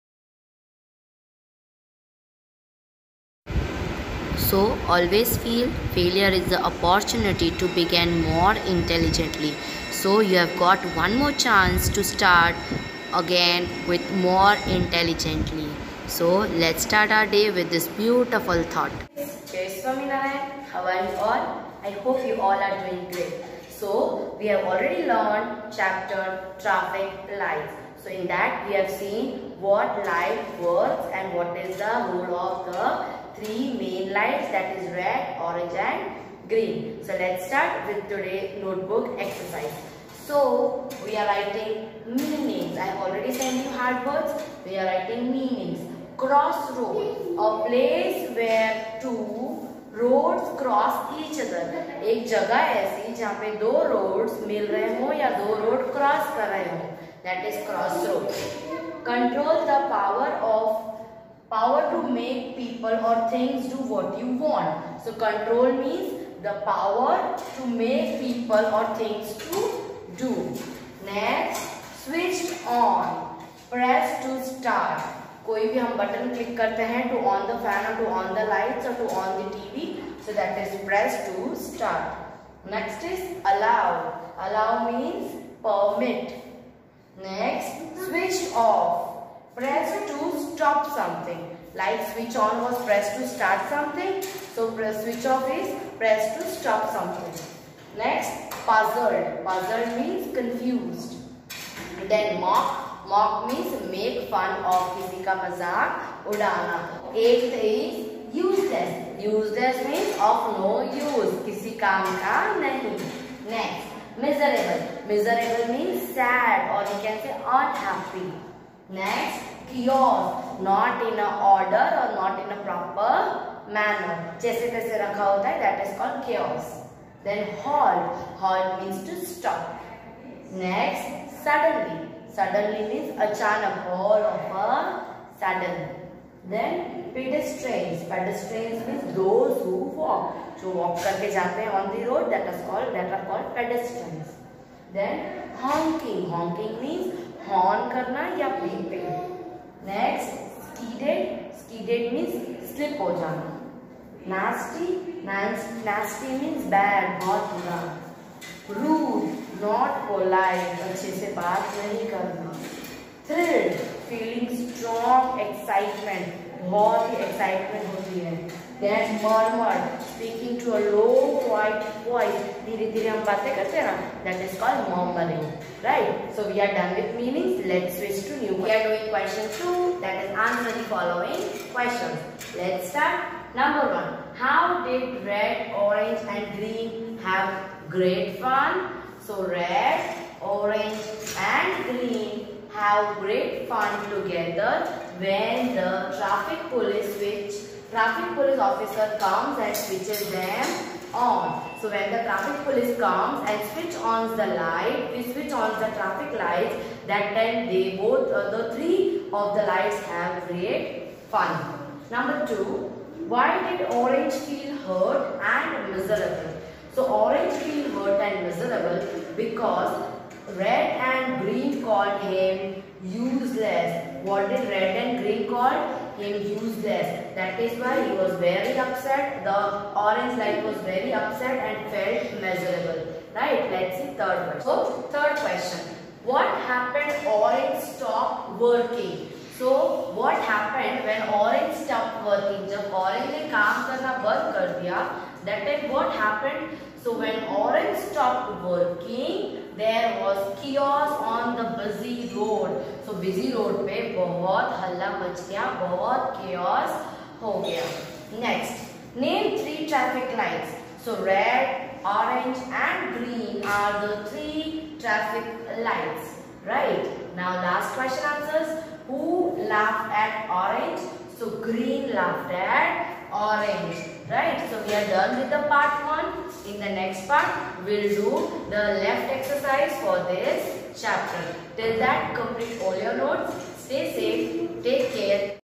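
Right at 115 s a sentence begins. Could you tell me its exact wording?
Miserable means sad or you can say unhappy.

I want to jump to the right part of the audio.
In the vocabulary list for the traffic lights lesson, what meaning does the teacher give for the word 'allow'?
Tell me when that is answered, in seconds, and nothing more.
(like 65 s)
84 s.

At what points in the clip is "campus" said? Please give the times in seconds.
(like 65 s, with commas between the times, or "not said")
not said.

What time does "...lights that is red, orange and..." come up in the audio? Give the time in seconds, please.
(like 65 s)
34 s.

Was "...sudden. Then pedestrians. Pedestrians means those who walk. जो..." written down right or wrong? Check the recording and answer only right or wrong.
right.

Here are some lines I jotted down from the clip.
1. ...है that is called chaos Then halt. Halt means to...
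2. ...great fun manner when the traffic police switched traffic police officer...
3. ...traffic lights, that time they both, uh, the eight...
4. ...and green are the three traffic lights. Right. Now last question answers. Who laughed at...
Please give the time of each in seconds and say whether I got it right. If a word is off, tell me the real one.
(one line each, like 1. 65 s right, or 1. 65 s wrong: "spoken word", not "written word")
1. 125 s right
2. 193 s wrong: "together", not "manner"
3. 205 s wrong: "three", not "eight"
4. 262 s right.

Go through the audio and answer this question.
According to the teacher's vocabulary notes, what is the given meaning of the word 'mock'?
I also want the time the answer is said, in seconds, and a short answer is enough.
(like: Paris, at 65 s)
Make fun of, at 103 s.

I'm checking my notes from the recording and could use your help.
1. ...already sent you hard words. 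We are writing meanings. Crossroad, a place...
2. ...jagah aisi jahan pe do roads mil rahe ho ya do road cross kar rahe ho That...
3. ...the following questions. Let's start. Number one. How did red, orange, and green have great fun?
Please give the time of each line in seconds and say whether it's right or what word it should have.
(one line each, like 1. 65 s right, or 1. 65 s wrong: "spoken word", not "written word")
1. 43 s right
2. 52 s right
3. 180 s right.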